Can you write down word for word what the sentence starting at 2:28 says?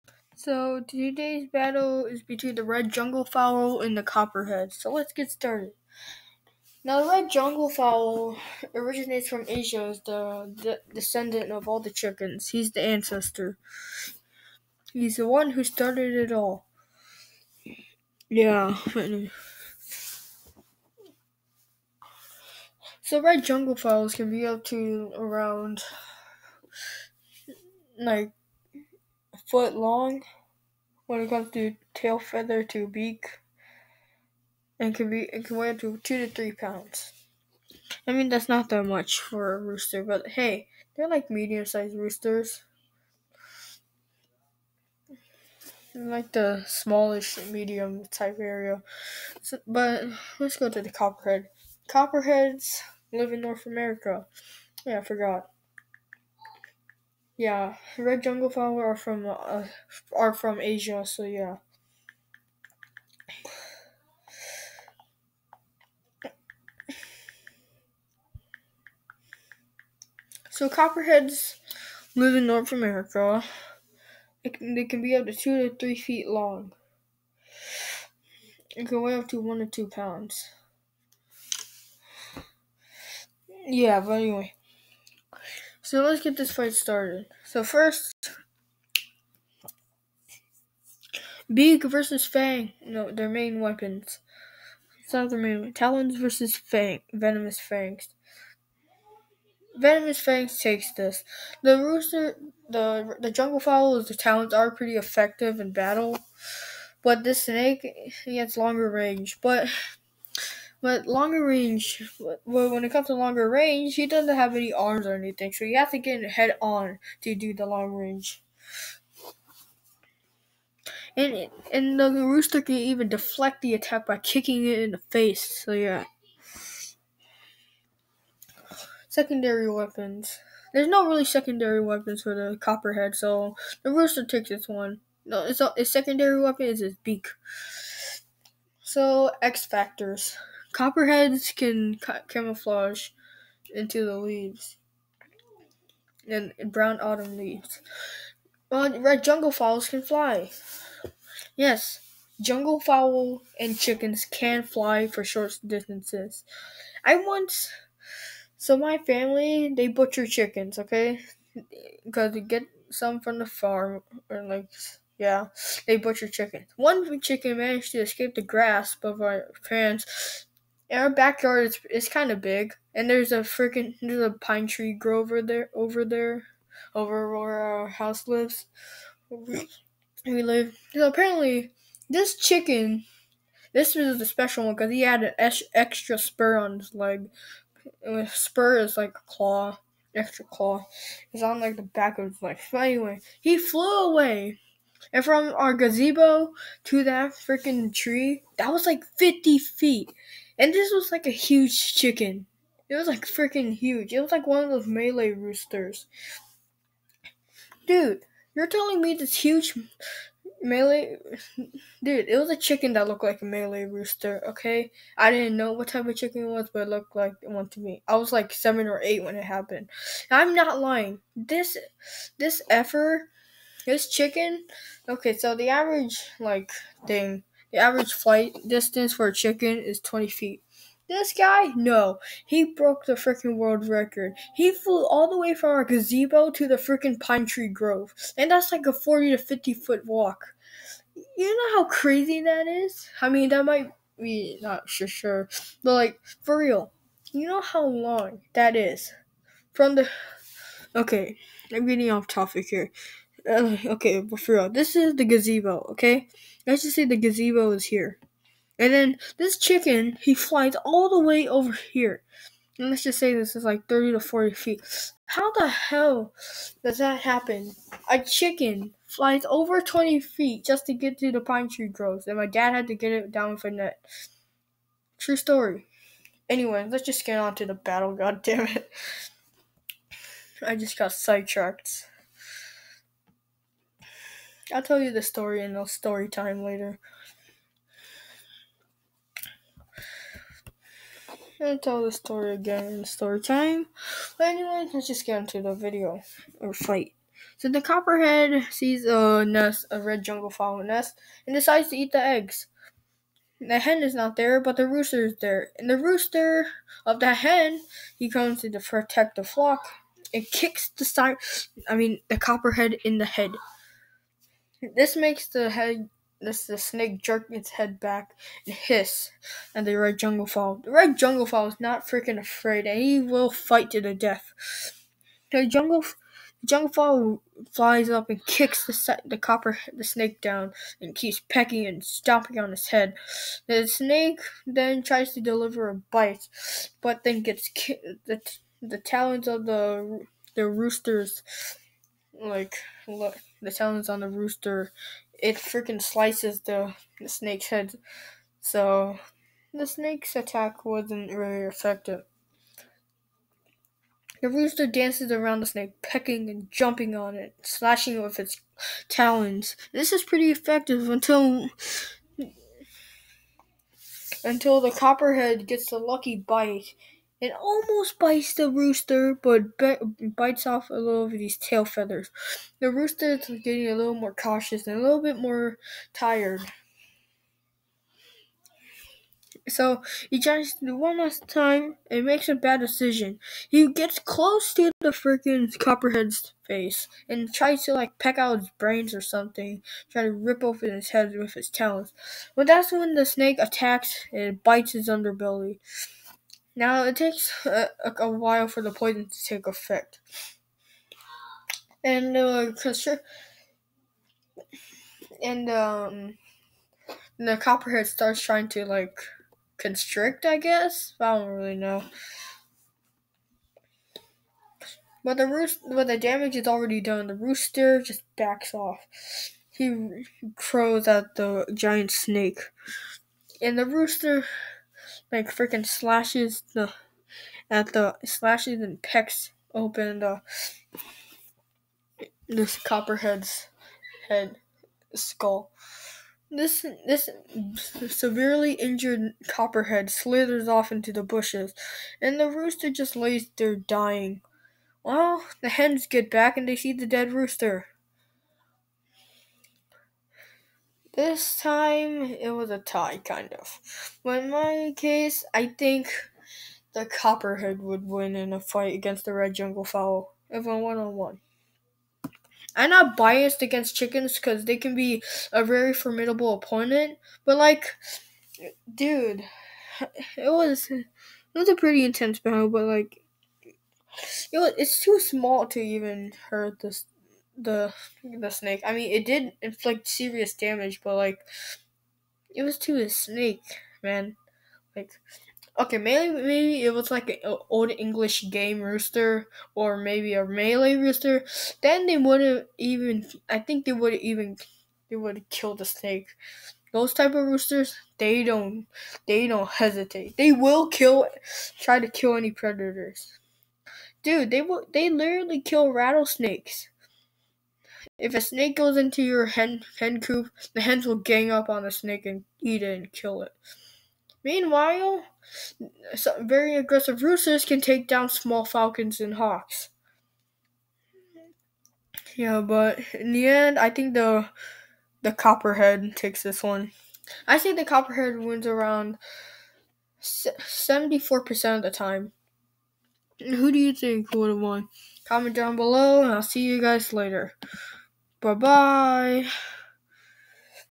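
Uh, red jungle fowls can fly.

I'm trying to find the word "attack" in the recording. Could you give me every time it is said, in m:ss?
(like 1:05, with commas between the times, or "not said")
2:03, 5:50, 6:33.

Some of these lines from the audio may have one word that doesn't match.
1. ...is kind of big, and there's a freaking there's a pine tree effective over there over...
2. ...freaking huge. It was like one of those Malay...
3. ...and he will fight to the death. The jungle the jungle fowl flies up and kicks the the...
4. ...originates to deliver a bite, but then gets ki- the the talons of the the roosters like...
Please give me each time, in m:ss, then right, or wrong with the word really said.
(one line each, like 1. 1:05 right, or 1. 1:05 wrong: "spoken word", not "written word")
1. 2:51 wrong: "grove", not "effective"
2. 3:23 right
3. 5:22 right
4. 5:35 wrong: "tries", not "originates".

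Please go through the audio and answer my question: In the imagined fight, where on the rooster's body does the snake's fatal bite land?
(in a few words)
underbelly.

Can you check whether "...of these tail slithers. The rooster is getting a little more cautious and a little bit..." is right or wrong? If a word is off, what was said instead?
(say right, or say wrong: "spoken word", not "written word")
wrong: "feathers", not "slithers".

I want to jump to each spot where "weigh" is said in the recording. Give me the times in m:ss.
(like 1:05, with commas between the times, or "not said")
0:35, 1:19.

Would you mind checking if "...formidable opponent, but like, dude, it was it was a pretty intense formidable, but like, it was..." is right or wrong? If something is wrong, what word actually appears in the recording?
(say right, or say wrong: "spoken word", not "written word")
wrong: "battle", not "formidable".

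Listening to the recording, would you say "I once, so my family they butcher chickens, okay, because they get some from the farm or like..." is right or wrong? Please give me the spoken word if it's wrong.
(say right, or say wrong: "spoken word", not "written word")
right.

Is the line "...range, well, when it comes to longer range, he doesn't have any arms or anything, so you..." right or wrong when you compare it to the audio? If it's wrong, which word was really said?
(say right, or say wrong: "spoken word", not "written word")
right.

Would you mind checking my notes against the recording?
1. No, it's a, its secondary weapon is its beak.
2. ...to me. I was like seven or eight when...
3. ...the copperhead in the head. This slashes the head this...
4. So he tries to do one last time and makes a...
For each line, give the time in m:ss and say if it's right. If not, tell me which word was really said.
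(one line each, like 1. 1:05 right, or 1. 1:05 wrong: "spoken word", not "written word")
1. 2:15 right
2. 3:37 right
3. 5:12 wrong: "makes", not "slashes"
4. 6:19 right.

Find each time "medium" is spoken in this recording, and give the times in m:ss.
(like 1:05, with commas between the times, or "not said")
0:41, 0:47.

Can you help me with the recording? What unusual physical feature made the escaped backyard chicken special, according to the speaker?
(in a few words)
extra spur.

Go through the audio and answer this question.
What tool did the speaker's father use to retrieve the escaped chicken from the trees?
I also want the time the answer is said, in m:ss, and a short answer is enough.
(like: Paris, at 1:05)
a net, at 4:33.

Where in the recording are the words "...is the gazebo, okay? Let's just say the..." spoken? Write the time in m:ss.
4:14.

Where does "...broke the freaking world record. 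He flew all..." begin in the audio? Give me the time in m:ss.
3:52.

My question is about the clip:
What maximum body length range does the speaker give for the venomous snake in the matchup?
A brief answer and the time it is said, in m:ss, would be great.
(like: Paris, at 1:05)
2 to 3 feet, at 1:15.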